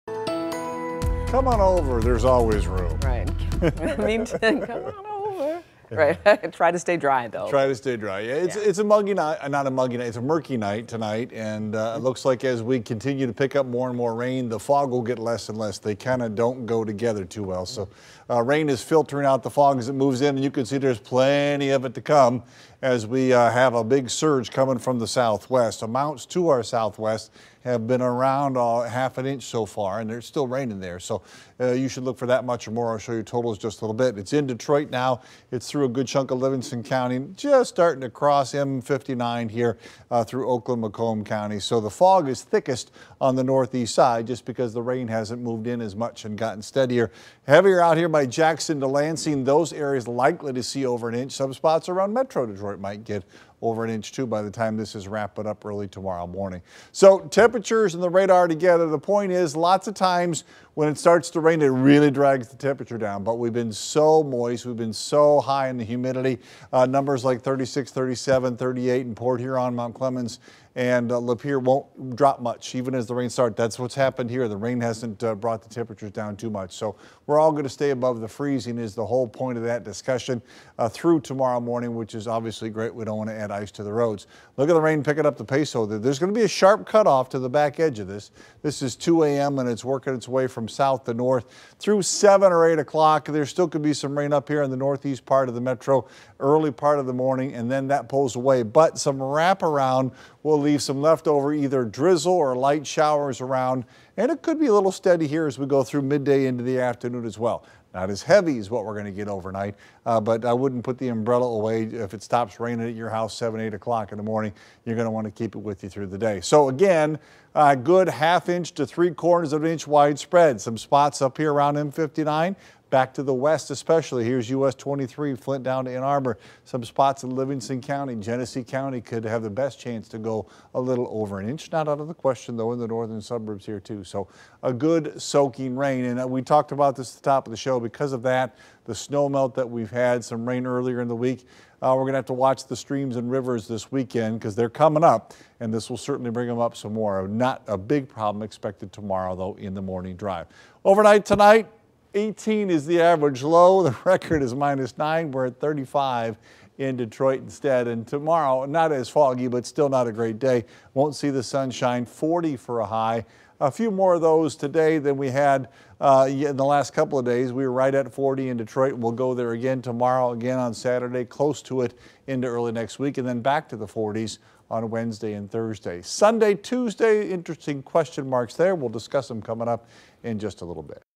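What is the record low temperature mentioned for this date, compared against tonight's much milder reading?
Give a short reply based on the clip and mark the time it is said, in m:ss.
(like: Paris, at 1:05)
-9, at 2:34.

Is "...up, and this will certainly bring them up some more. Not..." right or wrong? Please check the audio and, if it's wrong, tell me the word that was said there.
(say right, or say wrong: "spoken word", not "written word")
right.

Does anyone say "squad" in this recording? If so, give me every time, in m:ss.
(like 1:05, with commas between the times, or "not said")
not said.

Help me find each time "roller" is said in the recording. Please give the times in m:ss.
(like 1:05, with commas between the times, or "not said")
not said.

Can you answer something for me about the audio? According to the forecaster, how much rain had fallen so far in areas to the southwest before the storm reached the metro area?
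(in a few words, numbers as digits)
half an inch.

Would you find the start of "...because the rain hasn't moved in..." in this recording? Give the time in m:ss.
0:44.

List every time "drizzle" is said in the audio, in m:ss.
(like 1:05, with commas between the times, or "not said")
1:41.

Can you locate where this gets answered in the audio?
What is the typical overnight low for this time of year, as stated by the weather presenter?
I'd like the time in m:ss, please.
2:32.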